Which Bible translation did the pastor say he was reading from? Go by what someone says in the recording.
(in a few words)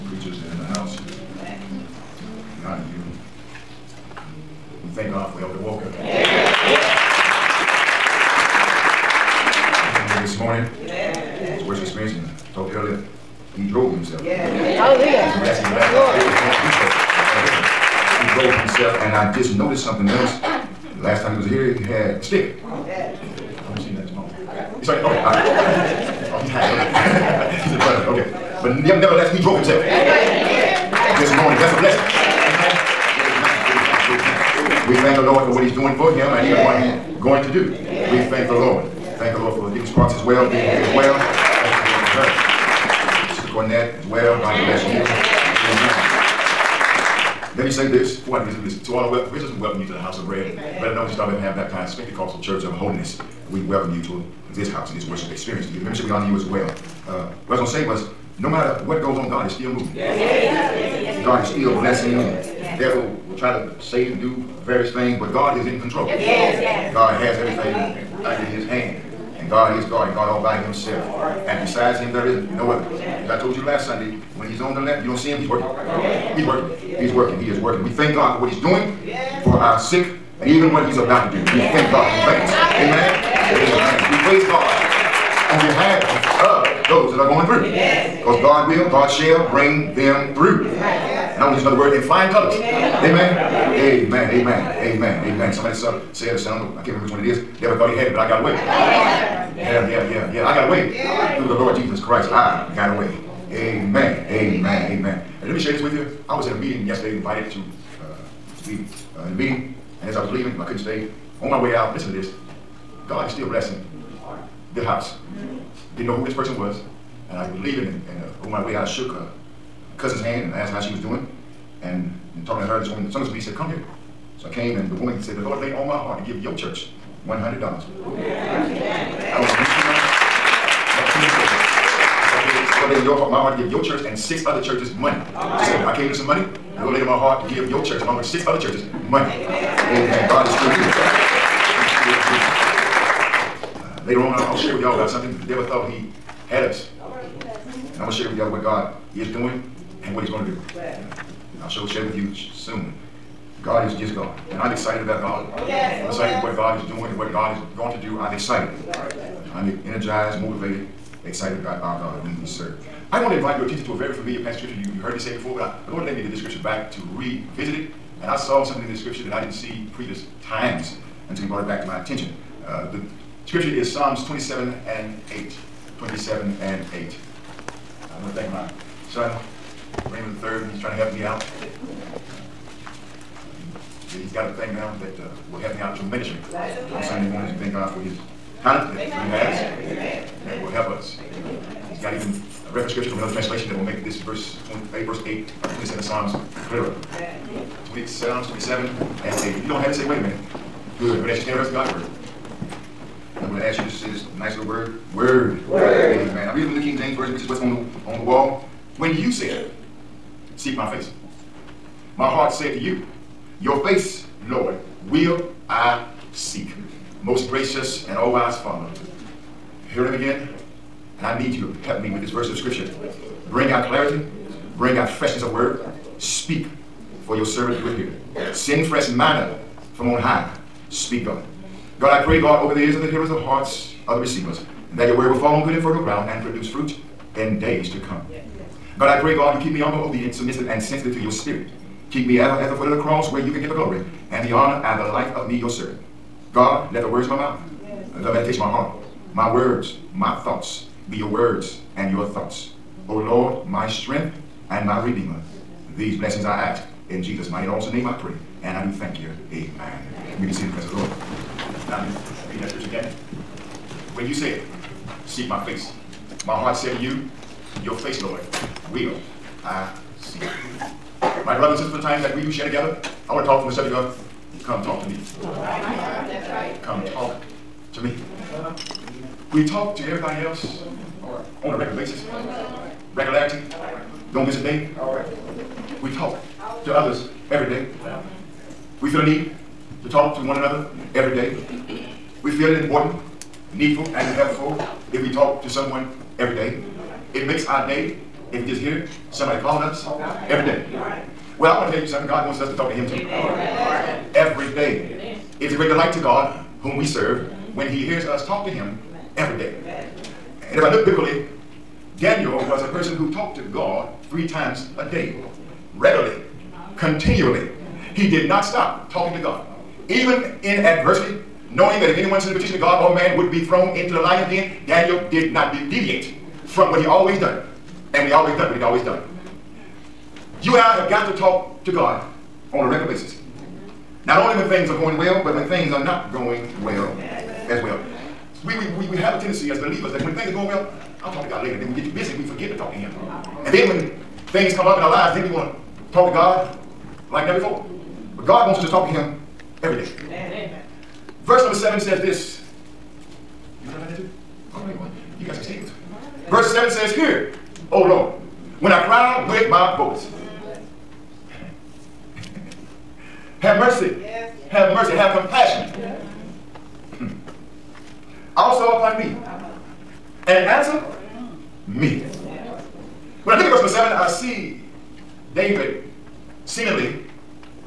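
King James Version.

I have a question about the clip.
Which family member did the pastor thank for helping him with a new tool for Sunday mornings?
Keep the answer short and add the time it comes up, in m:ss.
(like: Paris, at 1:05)
Raymond III, at 3:00.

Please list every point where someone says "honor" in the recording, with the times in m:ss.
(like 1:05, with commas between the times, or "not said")
0:56, 4:04.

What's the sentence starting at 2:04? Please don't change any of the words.
So I came, and the woman said, the Lord laid on my heart to give your church $100.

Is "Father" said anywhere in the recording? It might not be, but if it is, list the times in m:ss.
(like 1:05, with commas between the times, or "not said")
3:38.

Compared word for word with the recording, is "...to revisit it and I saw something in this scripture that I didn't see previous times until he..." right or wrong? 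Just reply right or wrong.
right.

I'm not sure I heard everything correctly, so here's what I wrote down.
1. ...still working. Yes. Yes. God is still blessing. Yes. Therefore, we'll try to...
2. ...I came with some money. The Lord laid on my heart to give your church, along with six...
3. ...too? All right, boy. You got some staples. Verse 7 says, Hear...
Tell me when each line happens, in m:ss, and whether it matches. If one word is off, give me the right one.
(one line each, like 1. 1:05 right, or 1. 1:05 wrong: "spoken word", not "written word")
1. 0:59 wrong: "moving", not "working"
2. 2:15 right
3. 5:54 right.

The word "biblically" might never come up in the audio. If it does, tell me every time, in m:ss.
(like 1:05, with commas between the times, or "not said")
5:11.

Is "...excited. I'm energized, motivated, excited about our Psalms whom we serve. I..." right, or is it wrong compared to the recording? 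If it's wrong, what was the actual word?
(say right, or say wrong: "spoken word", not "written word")
wrong: "God", not "Psalms".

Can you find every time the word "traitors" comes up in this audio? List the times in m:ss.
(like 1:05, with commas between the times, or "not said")
not said.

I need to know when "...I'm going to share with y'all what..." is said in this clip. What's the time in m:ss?
2:28.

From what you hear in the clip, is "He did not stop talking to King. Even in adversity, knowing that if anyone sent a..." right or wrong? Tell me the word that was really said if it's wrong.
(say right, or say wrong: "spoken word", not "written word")
wrong: "God", not "King".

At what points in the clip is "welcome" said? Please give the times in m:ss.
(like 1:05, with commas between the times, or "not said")
0:49, 0:53.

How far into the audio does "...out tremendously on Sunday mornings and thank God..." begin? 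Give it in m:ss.
3:05.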